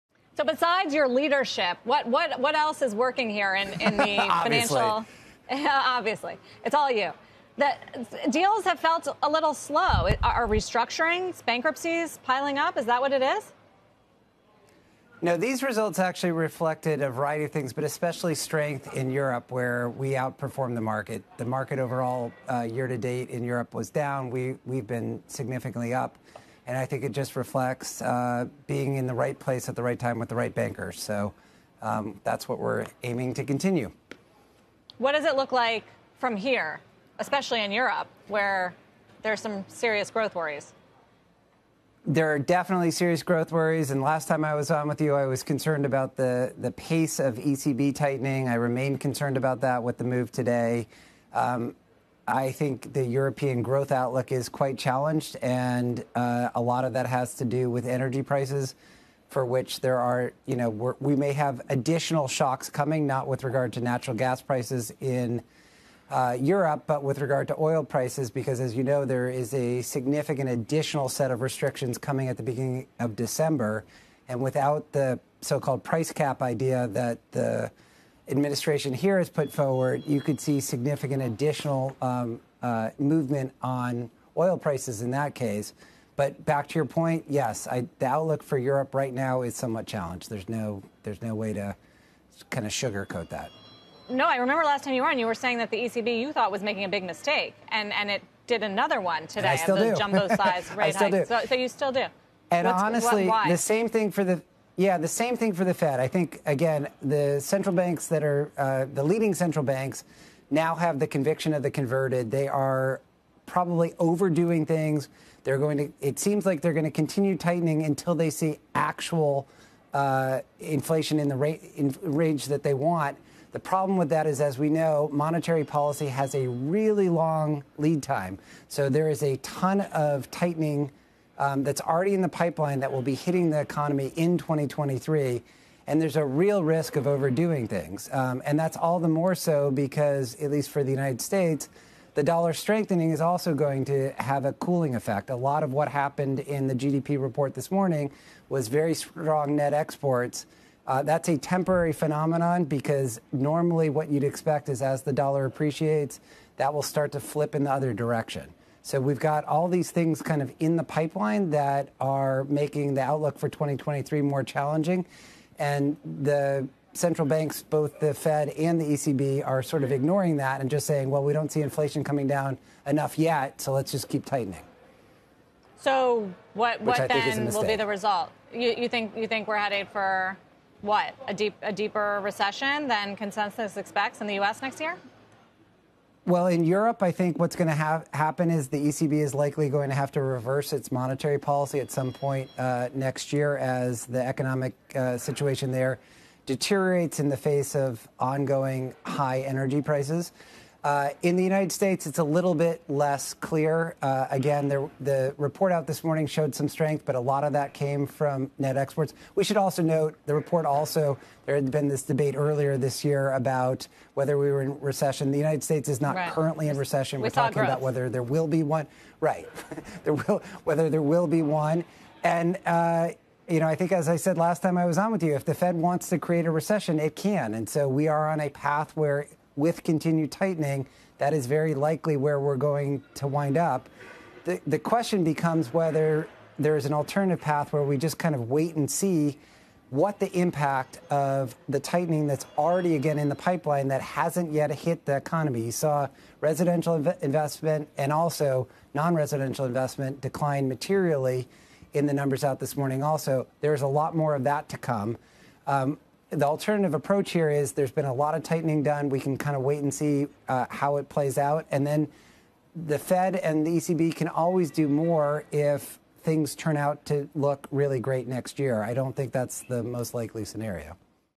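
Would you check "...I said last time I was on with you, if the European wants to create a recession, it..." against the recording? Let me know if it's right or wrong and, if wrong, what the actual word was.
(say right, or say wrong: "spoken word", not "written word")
wrong: "Fed", not "European".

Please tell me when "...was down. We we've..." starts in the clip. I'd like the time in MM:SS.
00:23.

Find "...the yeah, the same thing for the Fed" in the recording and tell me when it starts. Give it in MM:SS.
01:44.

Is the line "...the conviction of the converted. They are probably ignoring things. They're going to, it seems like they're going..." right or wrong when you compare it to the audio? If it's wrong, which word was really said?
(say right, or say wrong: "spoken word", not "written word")
wrong: "overdoing", not "ignoring".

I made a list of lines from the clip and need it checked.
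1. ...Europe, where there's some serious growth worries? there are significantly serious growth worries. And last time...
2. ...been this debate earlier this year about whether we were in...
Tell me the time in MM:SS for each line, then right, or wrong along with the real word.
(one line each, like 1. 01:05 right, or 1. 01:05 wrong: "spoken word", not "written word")
1. 00:37 wrong: "definitely", not "significantly"
2. 03:31 right.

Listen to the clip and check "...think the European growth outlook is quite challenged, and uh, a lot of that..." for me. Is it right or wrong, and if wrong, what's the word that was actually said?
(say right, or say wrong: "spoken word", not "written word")
right.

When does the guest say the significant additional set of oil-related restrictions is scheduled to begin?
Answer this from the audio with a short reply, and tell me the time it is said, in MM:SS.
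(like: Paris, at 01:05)
beginning of December, at 01:12.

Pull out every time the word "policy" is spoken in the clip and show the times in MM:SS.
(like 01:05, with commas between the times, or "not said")
02:05, 03:11.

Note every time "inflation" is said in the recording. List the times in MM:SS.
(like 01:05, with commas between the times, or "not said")
02:00, 02:51.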